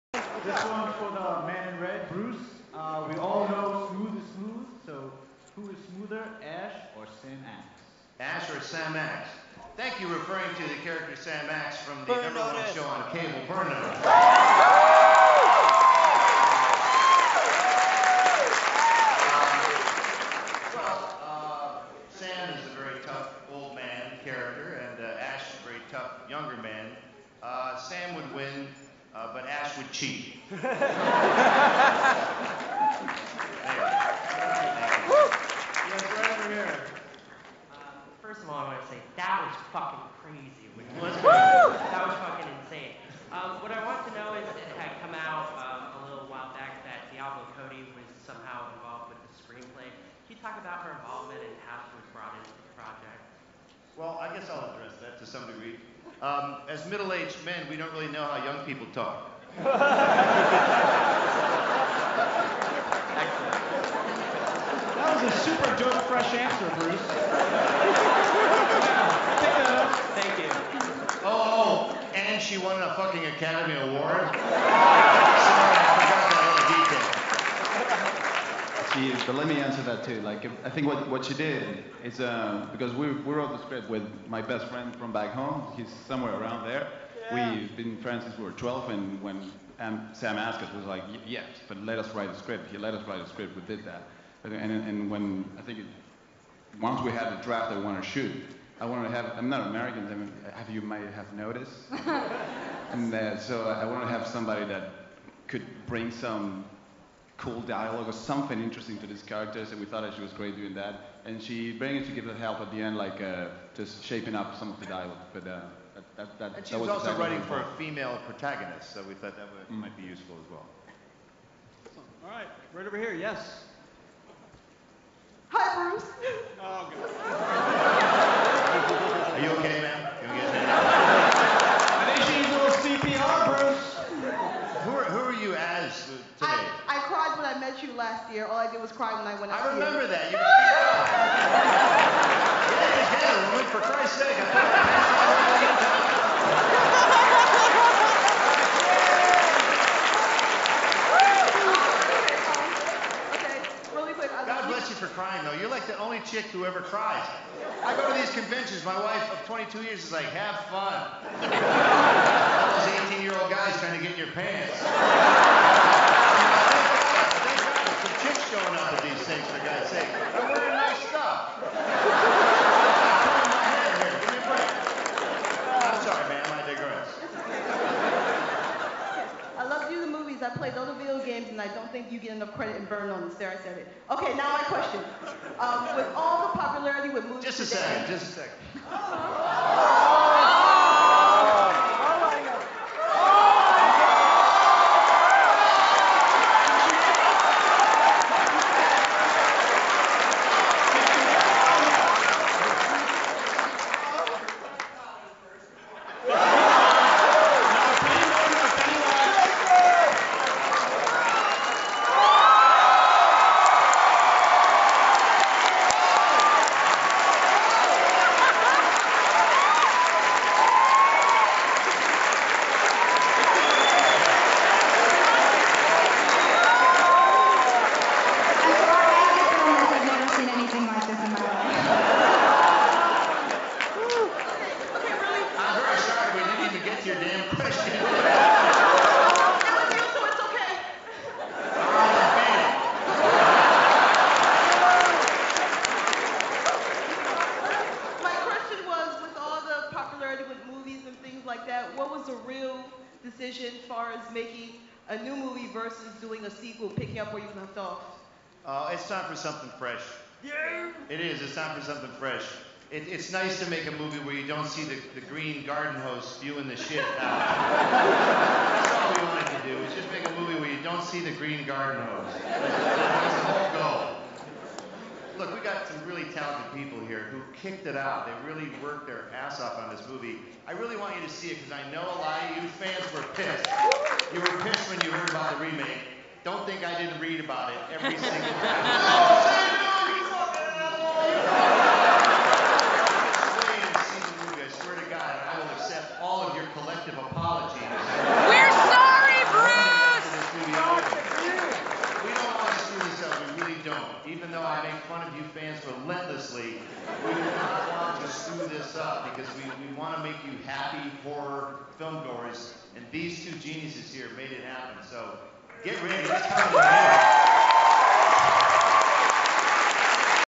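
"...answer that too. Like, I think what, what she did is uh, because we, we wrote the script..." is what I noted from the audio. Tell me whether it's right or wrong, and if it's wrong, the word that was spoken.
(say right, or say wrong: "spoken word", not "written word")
right.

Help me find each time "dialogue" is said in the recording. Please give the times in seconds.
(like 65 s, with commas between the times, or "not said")
107 s, 114 s.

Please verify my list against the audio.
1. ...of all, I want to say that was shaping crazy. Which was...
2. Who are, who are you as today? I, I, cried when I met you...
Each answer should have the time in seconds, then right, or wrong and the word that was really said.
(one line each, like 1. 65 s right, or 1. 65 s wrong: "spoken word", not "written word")
1. 38 s wrong: "fucking", not "shaping"
2. 134 s right.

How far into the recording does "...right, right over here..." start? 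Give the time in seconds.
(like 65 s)
122 s.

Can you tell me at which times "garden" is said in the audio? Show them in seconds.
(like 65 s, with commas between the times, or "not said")
265 s, 271 s.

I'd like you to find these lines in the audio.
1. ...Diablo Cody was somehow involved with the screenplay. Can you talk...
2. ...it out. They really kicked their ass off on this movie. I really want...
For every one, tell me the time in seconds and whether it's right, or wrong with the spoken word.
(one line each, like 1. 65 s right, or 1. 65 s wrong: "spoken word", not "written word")
1. 47 s right
2. 277 s wrong: "worked", not "kicked".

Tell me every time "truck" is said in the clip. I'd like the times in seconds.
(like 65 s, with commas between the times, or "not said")
not said.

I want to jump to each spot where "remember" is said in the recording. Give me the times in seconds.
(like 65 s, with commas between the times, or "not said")
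139 s.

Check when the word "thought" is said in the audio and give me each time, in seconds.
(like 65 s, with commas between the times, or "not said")
109 s, 119 s.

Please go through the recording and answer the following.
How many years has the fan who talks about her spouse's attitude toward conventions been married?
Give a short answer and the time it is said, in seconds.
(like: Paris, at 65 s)
22, at 159 s.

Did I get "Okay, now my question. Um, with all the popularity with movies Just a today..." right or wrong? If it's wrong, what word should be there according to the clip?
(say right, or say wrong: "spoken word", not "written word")
right.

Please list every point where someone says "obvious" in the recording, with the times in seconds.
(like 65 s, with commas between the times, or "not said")
not said.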